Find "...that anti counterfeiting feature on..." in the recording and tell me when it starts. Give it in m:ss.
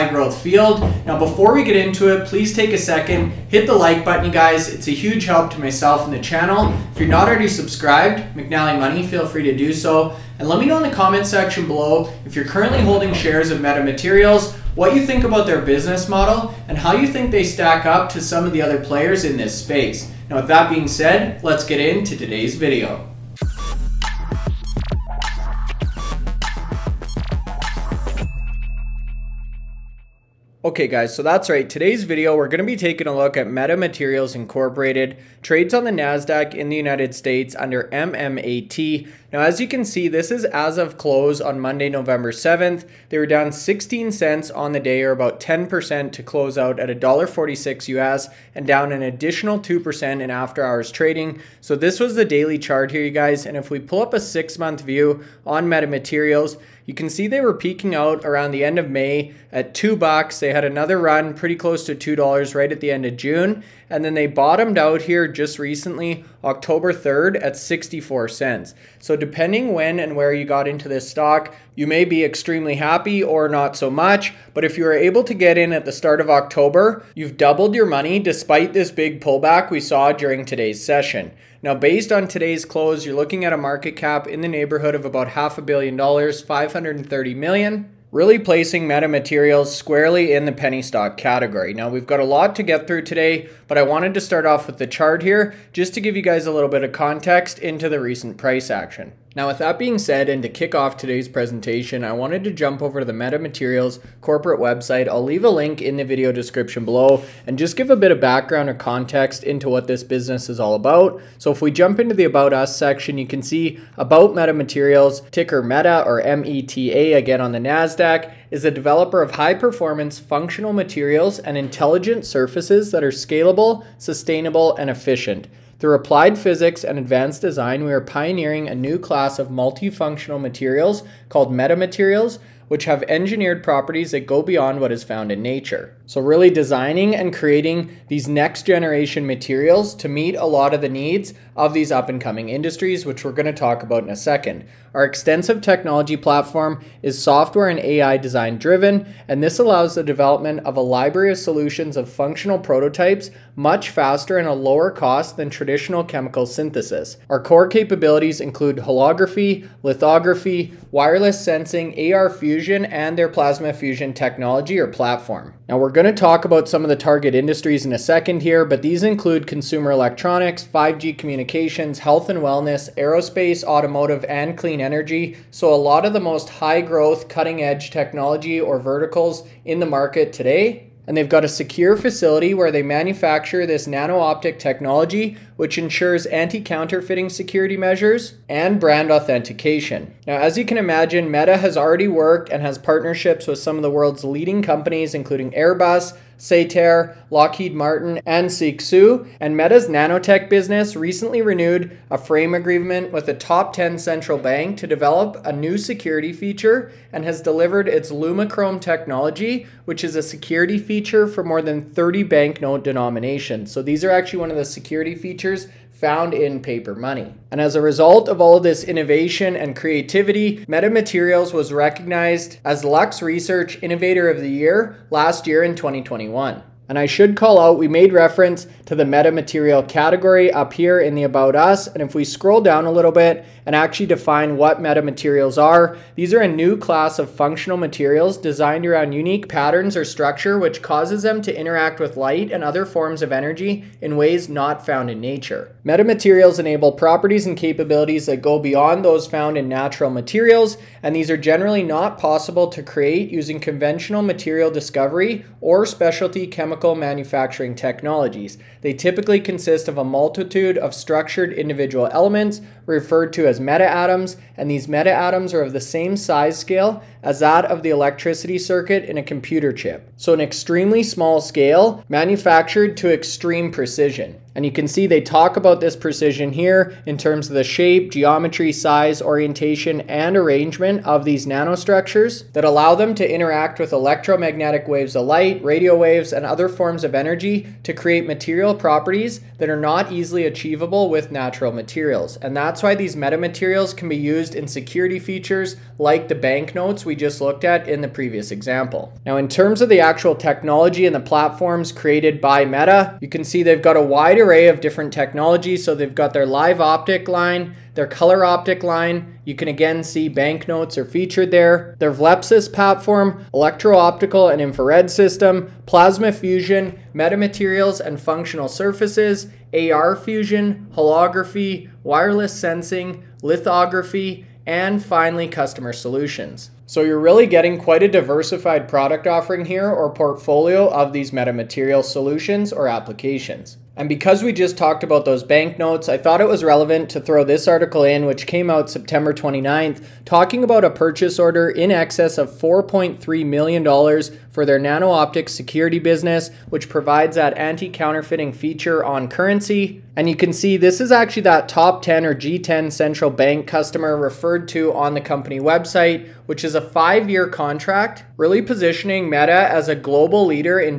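5:47.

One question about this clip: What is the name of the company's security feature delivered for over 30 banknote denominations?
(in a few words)
Lumachrome.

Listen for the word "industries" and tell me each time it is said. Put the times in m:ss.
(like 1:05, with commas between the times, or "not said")
2:22, 2:47.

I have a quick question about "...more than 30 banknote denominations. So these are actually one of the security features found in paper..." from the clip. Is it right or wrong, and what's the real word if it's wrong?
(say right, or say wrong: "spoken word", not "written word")
right.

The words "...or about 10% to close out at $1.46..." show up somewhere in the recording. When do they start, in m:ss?
0:45.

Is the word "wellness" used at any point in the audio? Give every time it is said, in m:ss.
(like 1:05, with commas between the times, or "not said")
2:52.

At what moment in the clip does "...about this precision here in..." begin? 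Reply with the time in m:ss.
4:35.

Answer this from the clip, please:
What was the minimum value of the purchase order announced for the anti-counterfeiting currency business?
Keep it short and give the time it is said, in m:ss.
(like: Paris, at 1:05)
$4.3 million, at 5:42.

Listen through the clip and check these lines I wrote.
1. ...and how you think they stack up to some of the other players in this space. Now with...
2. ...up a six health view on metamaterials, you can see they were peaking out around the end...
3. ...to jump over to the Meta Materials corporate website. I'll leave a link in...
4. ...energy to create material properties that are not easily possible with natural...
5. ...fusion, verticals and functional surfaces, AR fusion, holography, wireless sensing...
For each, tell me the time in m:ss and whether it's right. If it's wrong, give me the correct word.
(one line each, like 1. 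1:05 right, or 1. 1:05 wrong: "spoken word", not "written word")
1. 0:16 right
2. 0:54 wrong: "month", not "health"
3. 1:42 right
4. 4:47 wrong: "achievable", not "possible"
5. 5:16 wrong: "metamaterials", not "verticals".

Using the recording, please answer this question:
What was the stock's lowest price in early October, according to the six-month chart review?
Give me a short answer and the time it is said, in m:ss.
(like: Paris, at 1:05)
64 cents, at 1:07.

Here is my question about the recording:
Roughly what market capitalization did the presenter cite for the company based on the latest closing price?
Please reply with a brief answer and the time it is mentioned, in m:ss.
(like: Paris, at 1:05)
$530 million, at 1:26.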